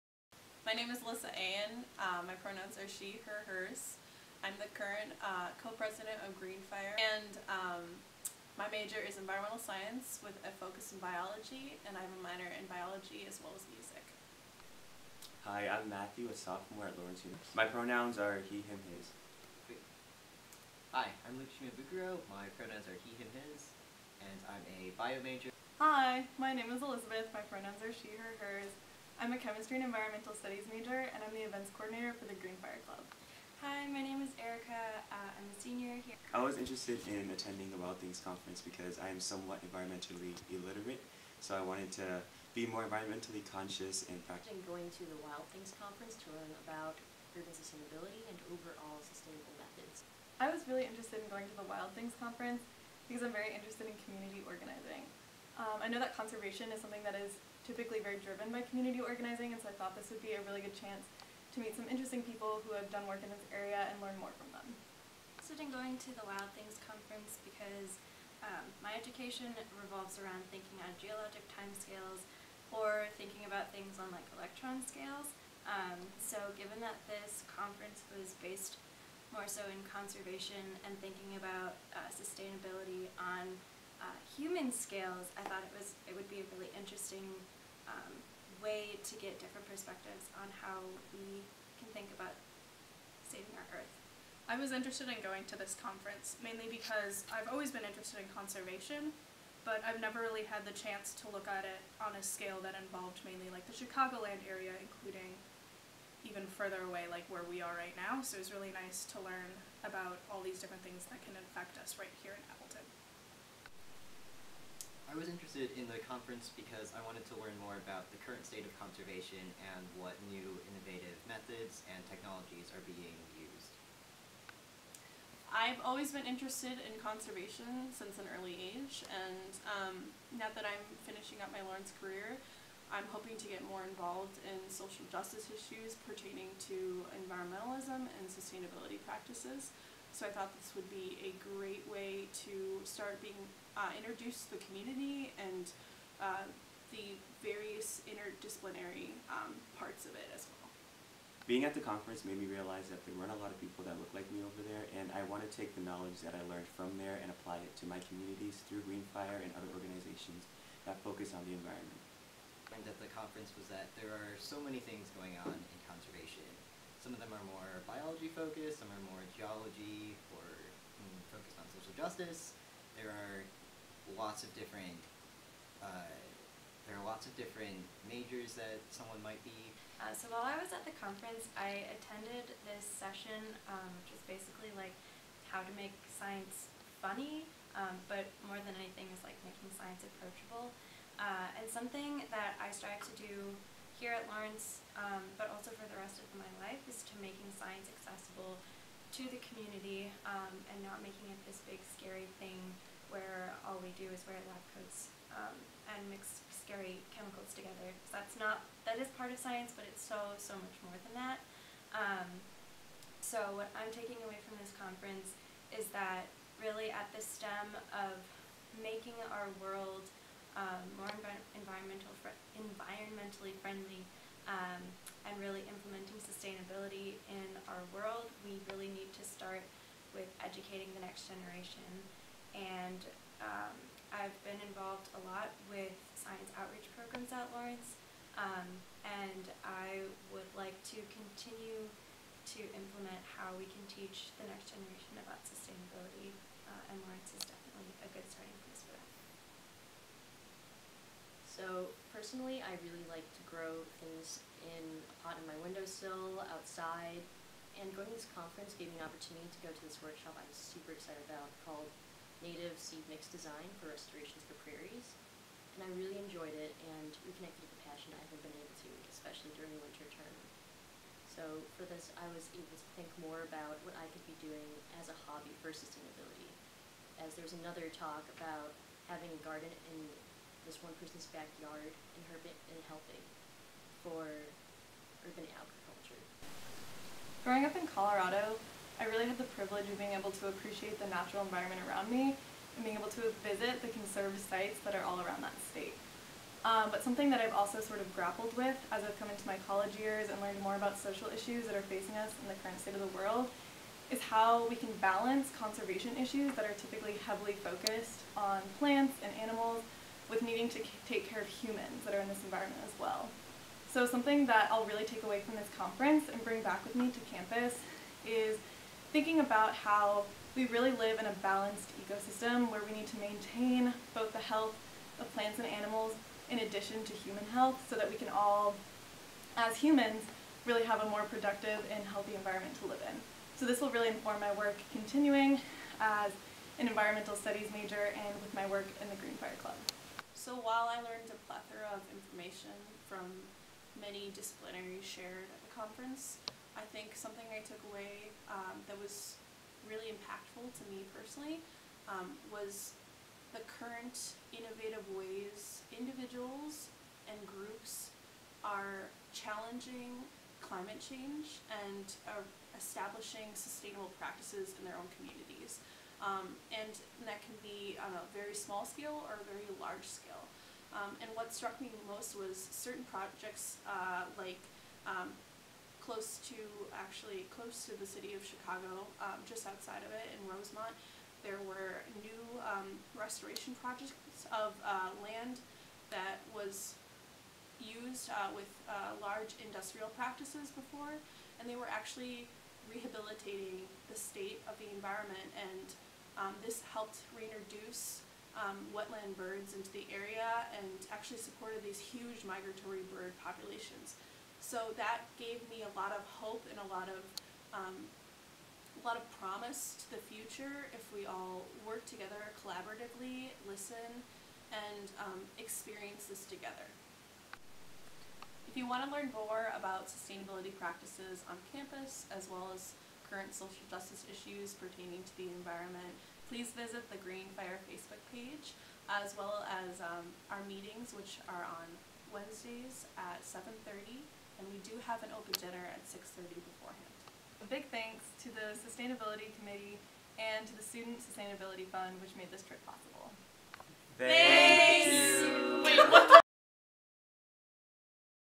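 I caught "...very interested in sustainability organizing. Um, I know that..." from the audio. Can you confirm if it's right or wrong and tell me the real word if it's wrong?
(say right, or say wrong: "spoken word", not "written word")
wrong: "community", not "sustainability".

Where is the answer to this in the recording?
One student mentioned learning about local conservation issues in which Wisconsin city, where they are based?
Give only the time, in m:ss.
1:52.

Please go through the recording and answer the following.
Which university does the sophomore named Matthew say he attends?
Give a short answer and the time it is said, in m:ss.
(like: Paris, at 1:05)
Lawrence University, at 0:16.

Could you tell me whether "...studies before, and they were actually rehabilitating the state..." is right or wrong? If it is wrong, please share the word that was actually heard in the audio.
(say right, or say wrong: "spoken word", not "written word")
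wrong: "practices", not "studies".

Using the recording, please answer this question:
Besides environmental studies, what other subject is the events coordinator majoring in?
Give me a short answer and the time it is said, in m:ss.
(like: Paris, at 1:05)
Chemistry, at 0:29.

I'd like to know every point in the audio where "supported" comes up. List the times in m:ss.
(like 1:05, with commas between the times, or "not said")
6:41.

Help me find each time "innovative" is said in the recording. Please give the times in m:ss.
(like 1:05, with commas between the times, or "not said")
2:00, 5:54.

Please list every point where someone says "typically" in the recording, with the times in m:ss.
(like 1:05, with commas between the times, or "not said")
0:57, 5:06.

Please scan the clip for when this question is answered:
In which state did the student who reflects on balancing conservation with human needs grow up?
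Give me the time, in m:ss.
4:47.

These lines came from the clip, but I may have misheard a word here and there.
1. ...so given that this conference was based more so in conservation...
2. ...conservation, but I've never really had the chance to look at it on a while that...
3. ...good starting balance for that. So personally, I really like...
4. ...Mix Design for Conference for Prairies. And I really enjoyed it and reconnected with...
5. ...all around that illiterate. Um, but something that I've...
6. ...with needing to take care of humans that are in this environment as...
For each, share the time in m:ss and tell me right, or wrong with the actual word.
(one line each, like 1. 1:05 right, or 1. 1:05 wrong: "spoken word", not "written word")
1. 1:16 right
2. 1:38 wrong: "scale", not "while"
3. 4:08 wrong: "place", not "balance"
4. 4:23 wrong: "Restorations", not "Conference"
5. 4:55 wrong: "state", not "illiterate"
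6. 5:10 right.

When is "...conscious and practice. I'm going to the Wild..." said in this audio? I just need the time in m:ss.
0:43.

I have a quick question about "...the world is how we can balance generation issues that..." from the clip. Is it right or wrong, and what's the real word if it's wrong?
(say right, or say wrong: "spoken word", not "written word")
wrong: "conservation", not "generation".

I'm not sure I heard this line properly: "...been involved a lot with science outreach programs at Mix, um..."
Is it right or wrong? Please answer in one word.
wrong.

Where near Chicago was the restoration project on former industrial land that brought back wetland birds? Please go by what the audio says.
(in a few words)
Rosemont.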